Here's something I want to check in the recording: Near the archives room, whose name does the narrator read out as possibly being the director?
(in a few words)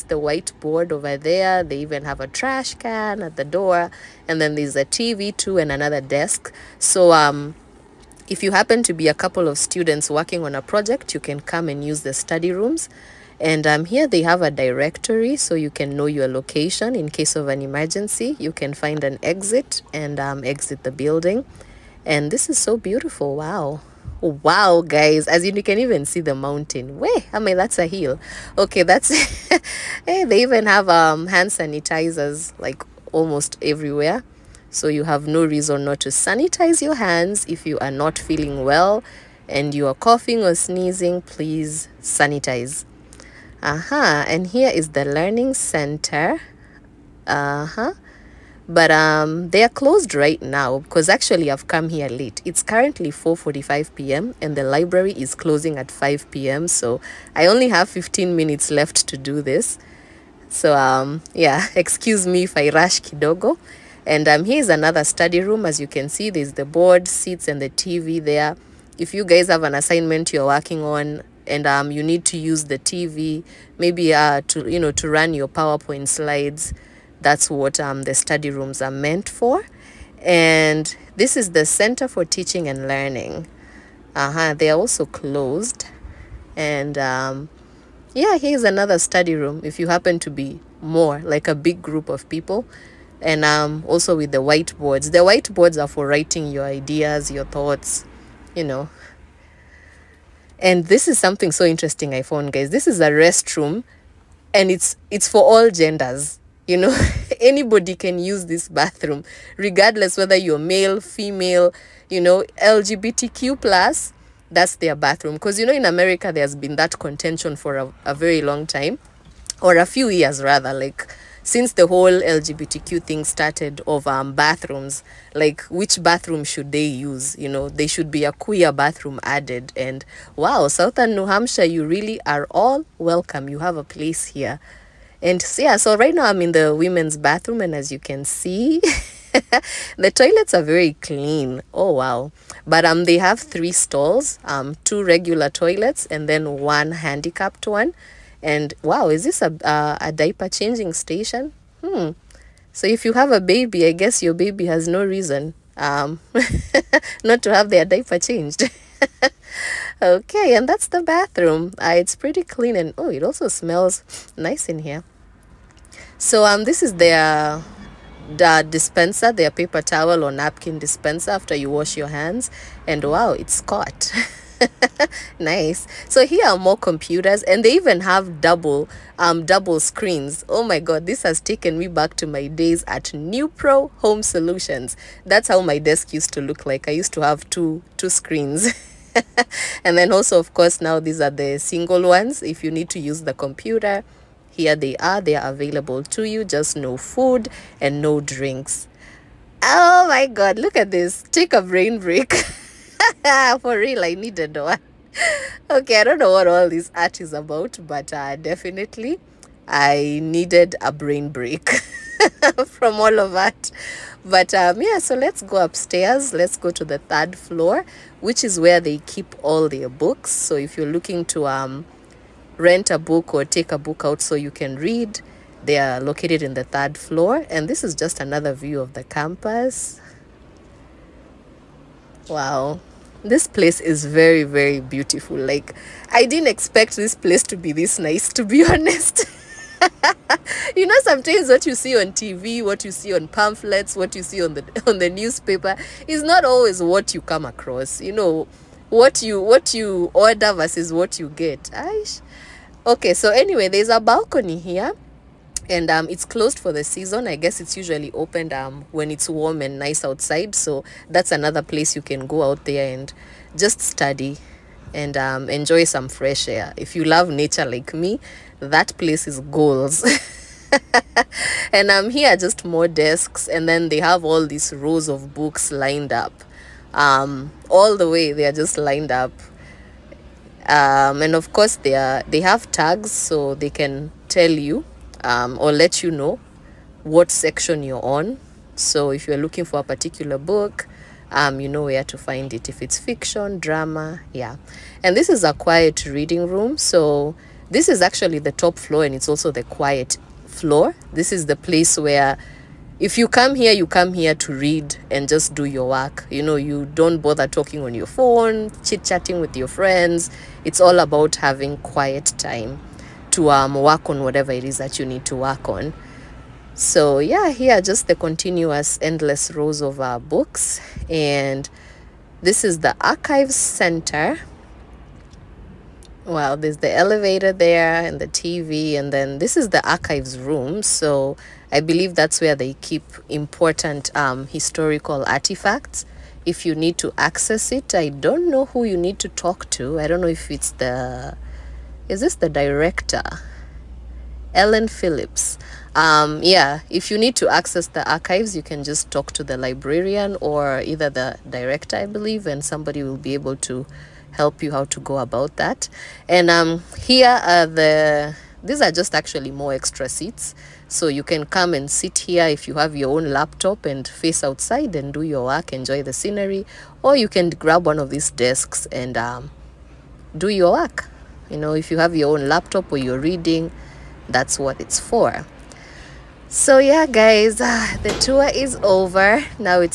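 Ellen Phillips.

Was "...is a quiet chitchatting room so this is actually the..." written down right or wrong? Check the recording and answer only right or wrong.
wrong.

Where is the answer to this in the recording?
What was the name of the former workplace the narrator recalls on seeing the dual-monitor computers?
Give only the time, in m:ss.
3:03.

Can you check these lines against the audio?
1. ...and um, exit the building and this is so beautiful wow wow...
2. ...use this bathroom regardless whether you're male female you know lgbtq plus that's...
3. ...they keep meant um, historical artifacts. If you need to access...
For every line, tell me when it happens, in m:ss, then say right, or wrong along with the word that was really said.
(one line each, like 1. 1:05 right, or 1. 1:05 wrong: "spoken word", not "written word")
1. 0:19 right
2. 1:48 right
3. 5:32 wrong: "important", not "meant".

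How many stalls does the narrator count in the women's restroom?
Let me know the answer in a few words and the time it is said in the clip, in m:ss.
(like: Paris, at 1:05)
3, at 2:23.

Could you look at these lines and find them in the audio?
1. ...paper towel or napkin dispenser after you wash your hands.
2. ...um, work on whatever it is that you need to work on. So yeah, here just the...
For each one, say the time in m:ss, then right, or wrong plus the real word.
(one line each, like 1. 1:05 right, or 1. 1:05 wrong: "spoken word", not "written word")
1. 2:49 right
2. 5:13 right.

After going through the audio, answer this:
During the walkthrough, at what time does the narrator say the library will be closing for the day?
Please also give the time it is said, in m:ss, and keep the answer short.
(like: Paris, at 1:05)
5 p.m., at 0:55.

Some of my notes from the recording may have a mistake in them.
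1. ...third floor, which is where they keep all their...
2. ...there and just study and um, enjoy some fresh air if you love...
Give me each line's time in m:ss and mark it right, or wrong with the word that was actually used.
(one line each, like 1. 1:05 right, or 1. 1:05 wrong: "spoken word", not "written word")
1. 3:36 right
2. 4:22 right.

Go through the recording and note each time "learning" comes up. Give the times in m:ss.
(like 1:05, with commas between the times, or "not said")
0:45, 1:22.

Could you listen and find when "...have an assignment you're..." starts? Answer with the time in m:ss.
1:09.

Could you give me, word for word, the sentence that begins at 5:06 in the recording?
You know, you don't bother talking on your phone, chit-chatting with your friends.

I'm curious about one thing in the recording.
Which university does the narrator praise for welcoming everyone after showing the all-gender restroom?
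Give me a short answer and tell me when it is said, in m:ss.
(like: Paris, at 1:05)
Southern New Hampshire, at 2:10.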